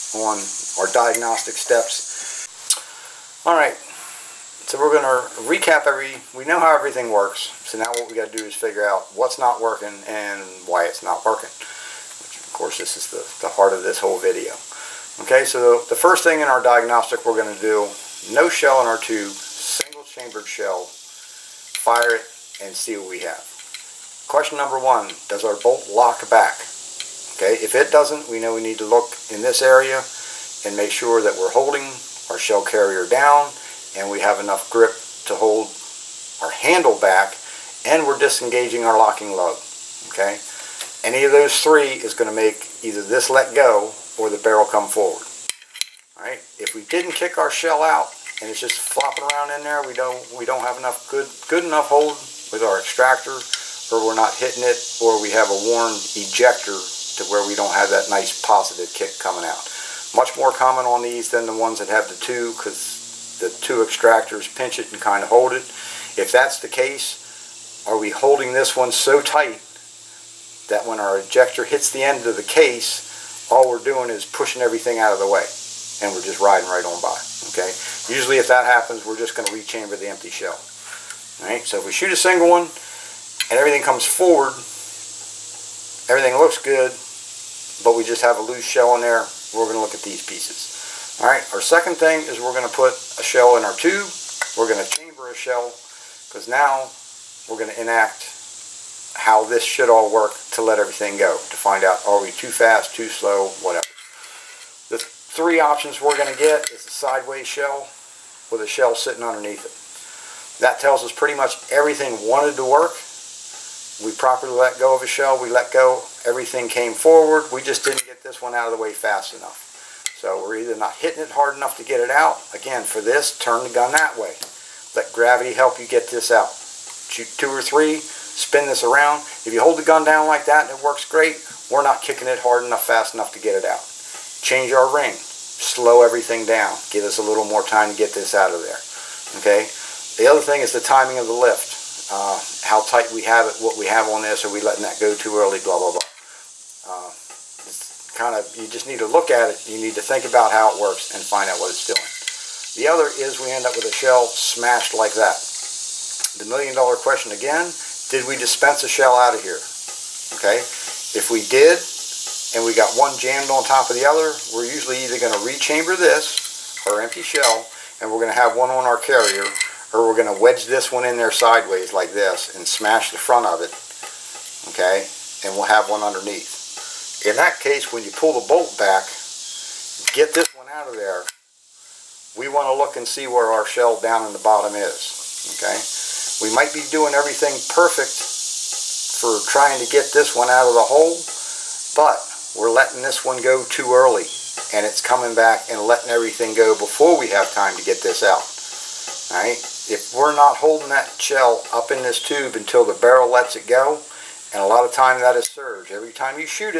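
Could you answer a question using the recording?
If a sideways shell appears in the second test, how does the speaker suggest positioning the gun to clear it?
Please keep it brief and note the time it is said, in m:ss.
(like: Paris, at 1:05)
Let gravity help, at 2:04.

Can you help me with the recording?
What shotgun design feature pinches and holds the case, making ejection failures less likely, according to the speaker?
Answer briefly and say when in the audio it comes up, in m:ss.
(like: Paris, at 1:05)
Two extractors, at 1:03.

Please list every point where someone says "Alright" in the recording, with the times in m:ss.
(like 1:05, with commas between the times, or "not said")
1:21, 1:31.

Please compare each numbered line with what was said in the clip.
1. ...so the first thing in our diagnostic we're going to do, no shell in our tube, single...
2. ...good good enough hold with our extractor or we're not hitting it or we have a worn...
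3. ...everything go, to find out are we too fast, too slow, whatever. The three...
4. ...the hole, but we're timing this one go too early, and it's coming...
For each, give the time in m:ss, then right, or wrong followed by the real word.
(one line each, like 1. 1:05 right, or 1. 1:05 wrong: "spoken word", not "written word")
1. 0:15 right
2. 0:51 right
3. 1:40 right
4. 3:10 wrong: "letting", not "timing".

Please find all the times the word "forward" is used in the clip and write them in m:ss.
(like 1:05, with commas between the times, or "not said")
0:44, 1:24, 1:56.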